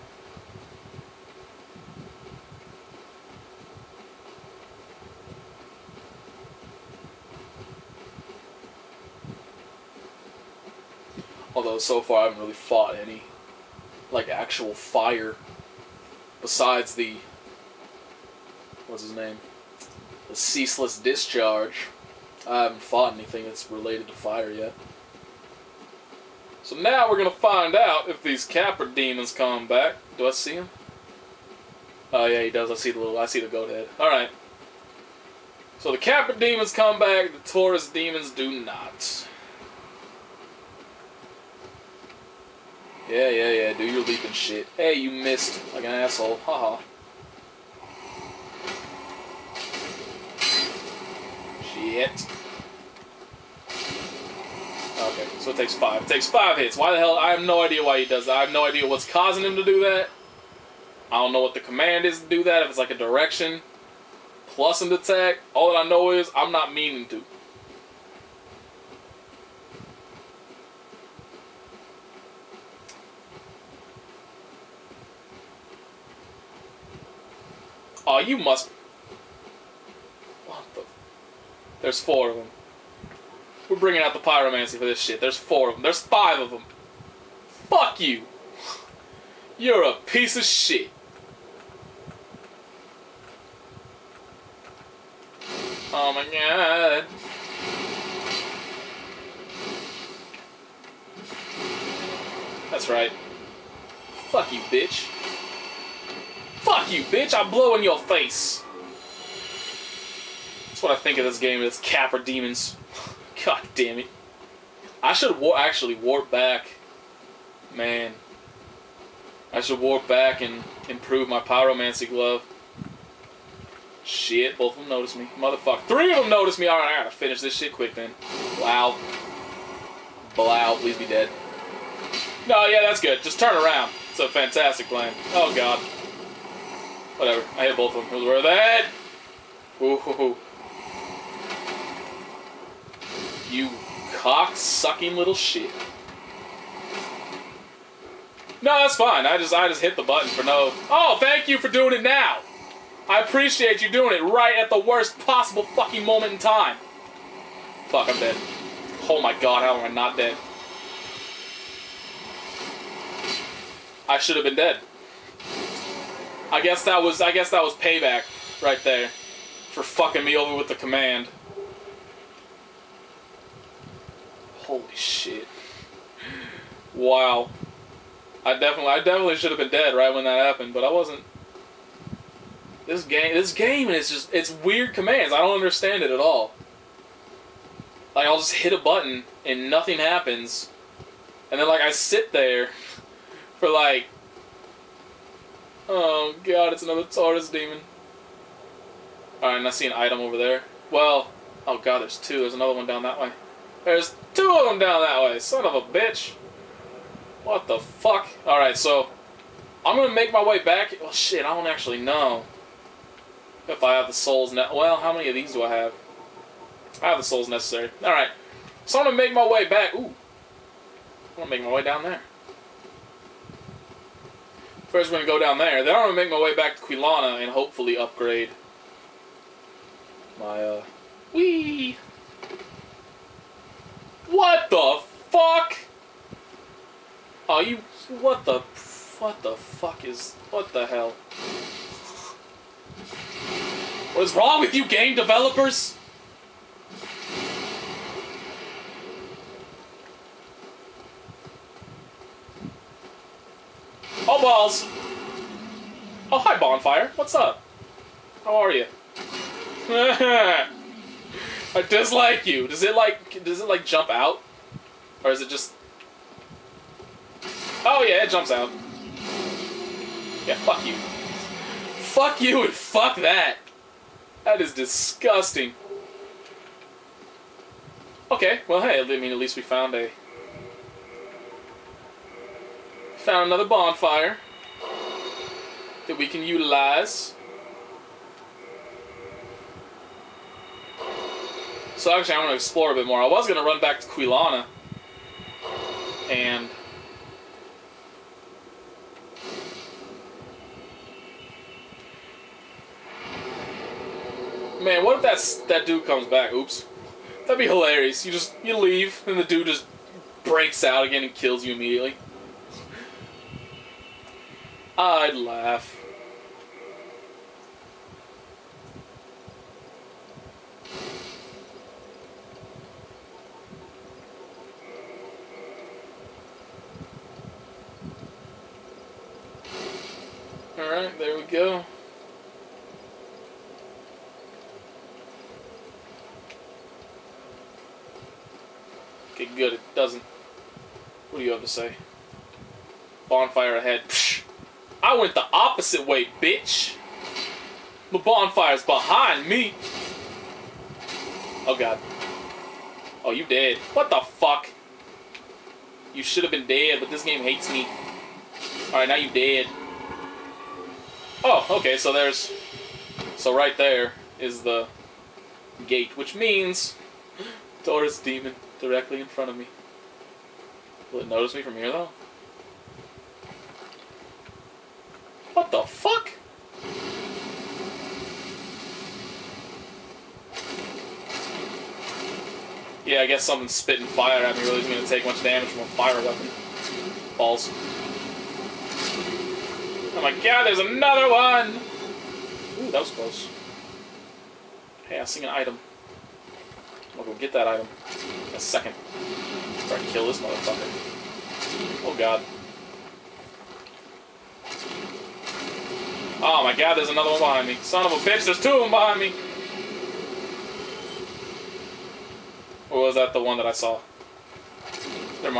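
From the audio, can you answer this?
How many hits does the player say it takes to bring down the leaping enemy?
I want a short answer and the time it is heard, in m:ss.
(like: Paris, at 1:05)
5, at 0:56.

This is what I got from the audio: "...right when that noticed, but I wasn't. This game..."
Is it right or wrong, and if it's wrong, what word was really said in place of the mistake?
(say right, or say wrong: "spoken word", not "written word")
wrong: "happened", not "noticed".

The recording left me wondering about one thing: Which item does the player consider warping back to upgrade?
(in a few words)
Pyromancy glove.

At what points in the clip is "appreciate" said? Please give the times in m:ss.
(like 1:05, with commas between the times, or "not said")
2:33.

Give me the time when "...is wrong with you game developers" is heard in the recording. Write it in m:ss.
4:04.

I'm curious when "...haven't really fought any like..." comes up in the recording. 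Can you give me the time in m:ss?
0:12.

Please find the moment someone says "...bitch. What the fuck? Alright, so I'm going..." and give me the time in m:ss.
3:25.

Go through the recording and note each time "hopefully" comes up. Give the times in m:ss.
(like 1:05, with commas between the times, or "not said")
3:47.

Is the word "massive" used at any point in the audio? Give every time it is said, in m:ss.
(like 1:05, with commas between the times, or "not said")
not said.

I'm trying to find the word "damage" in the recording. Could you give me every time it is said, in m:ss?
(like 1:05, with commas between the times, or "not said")
6:25.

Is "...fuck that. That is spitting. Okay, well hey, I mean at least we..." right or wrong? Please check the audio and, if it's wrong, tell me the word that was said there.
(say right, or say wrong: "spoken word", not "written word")
wrong: "disgusting", not "spitting".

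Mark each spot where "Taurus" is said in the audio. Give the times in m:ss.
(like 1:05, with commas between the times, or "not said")
0:37, 3:17, 6:07.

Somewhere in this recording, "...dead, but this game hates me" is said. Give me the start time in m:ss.
5:56.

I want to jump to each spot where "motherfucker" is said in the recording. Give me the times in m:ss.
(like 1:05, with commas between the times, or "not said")
2:05, 6:40.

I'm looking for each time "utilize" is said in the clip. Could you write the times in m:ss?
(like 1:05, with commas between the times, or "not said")
4:46.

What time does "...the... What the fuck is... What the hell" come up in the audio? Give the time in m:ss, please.
3:58.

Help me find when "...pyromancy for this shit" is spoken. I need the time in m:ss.
1:24.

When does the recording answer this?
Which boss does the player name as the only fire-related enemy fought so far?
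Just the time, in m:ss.
0:20.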